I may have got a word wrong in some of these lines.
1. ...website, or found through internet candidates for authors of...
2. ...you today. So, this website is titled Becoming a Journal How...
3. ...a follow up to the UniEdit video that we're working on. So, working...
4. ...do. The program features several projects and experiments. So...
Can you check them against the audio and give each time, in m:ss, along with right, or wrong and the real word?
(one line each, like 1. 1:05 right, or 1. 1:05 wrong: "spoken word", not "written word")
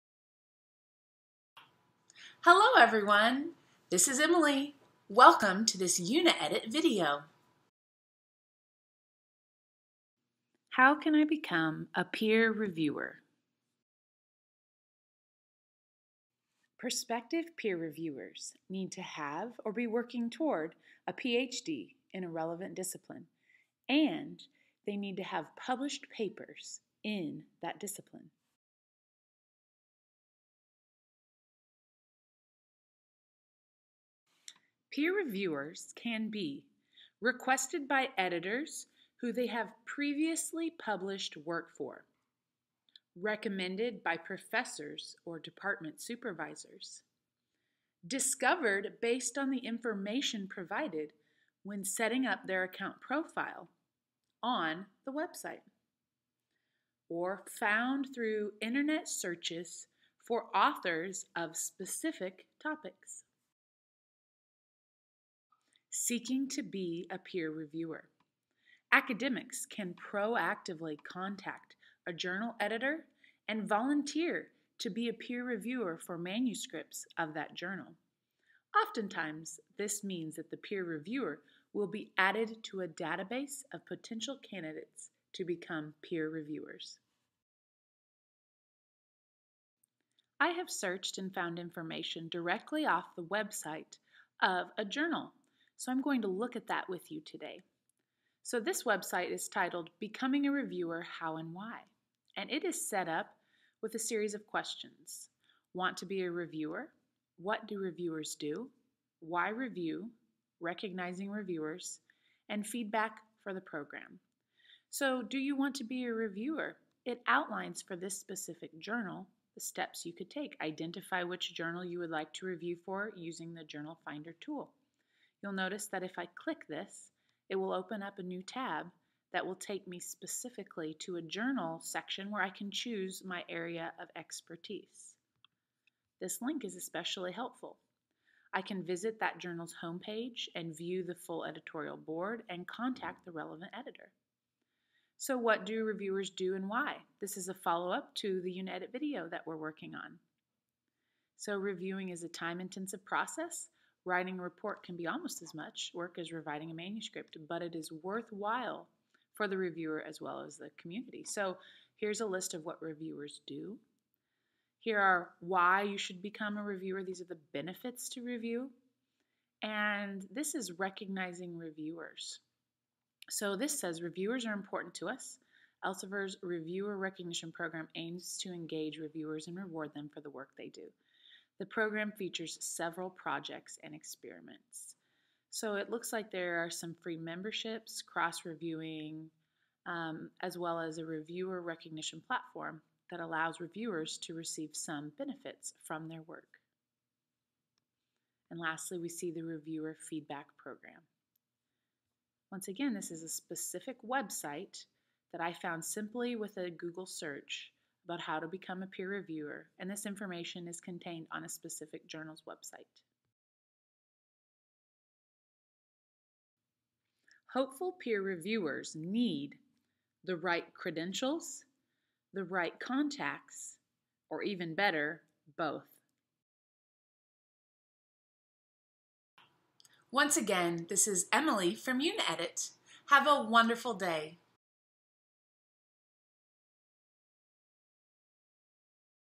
1. 0:55 wrong: "searches", not "candidates"
2. 1:37 wrong: "Reviewer", not "Journal"
3. 2:27 wrong: "reviewing", not "working"
4. 3:00 right.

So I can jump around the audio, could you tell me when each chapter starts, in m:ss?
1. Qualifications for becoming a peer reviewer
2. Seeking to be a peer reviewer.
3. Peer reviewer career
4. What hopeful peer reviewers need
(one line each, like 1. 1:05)
1. 0:13
2. 1:05
3. 1:28
4. 3:34.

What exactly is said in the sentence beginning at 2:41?
So here's a list of what reviewers do.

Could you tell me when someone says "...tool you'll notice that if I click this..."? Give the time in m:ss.
2:04.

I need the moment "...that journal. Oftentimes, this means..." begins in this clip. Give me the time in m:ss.
1:17.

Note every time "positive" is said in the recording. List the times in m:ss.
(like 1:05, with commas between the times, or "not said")
not said.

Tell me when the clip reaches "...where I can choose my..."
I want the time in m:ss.
2:12.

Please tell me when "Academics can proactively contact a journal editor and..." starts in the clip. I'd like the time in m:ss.
1:08.